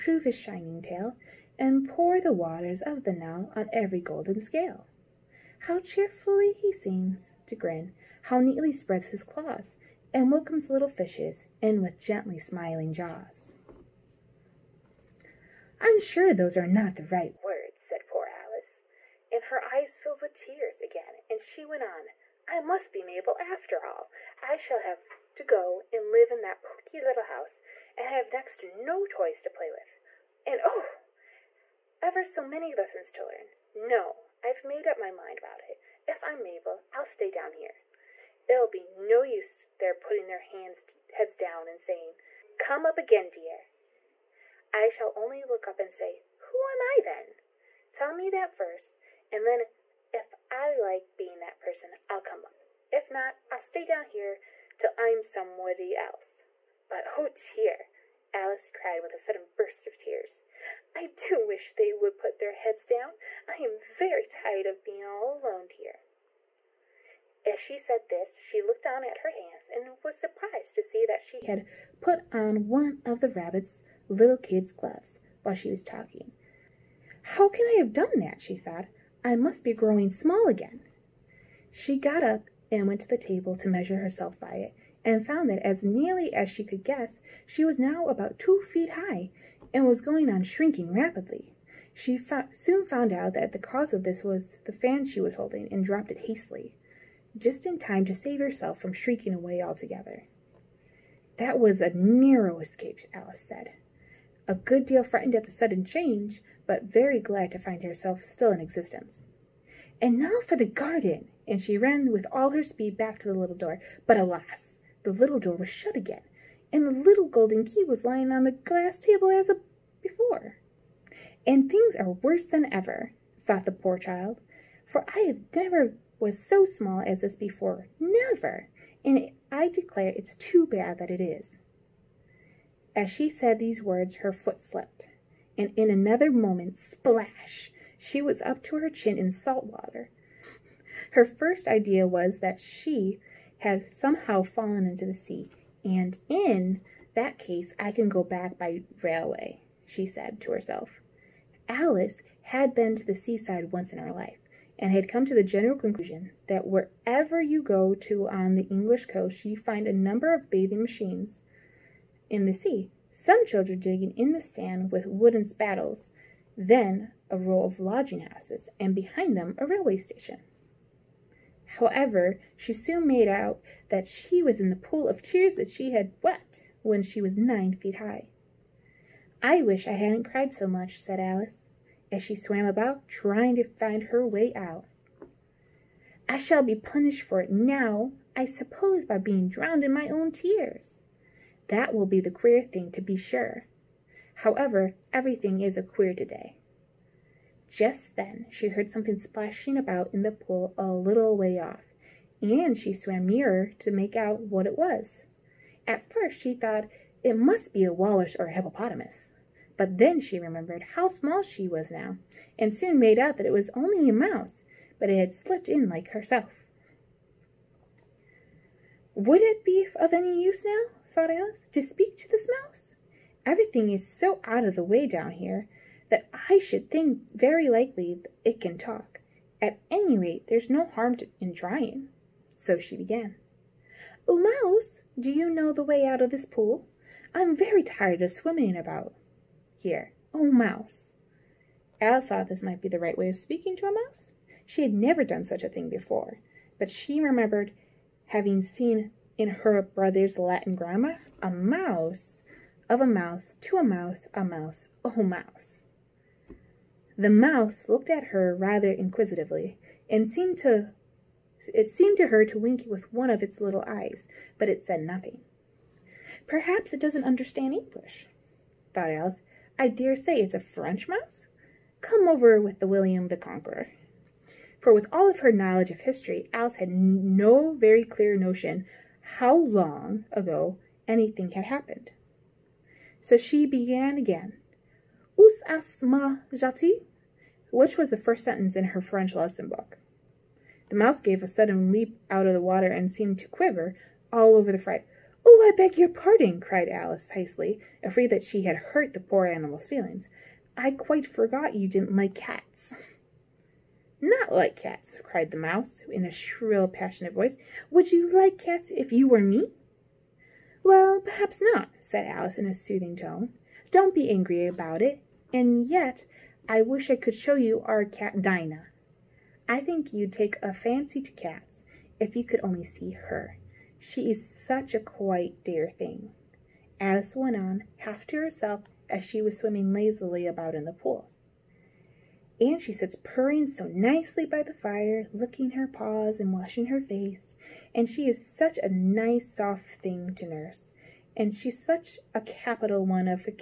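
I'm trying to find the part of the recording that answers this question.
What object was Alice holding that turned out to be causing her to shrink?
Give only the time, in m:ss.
1:34.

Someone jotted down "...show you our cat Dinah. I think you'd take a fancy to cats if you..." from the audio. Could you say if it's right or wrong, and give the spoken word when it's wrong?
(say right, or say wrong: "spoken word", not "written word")
right.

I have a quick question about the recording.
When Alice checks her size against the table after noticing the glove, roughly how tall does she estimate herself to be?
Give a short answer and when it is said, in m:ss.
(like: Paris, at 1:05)
2 feet, at 1:28.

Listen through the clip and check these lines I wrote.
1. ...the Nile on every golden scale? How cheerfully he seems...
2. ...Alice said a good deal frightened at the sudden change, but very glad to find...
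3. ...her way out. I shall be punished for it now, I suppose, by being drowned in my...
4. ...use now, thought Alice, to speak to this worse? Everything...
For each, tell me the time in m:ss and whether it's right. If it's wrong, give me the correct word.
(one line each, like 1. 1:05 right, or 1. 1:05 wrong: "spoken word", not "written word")
1. 0:03 right
2. 1:43 right
3. 3:04 right
4. 3:40 wrong: "mouse", not "worse".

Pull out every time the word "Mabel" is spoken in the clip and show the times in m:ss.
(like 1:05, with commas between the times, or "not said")
0:23, 0:36.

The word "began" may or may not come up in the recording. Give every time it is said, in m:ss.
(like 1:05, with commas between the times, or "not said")
3:52, 4:43.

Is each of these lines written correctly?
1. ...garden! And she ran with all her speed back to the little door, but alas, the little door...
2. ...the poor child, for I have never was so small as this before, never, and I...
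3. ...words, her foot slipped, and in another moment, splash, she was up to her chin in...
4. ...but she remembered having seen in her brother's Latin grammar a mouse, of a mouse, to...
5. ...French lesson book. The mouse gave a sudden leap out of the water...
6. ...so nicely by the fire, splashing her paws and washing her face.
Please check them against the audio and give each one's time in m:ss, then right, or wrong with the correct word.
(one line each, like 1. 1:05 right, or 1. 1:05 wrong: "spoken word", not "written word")
1. 1:50 right
2. 2:03 right
3. 2:13 right
4. 4:06 right
5. 4:49 right
6. 5:33 wrong: "licking", not "splashing".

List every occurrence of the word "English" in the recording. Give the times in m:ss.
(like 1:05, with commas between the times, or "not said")
2:38, 4:27.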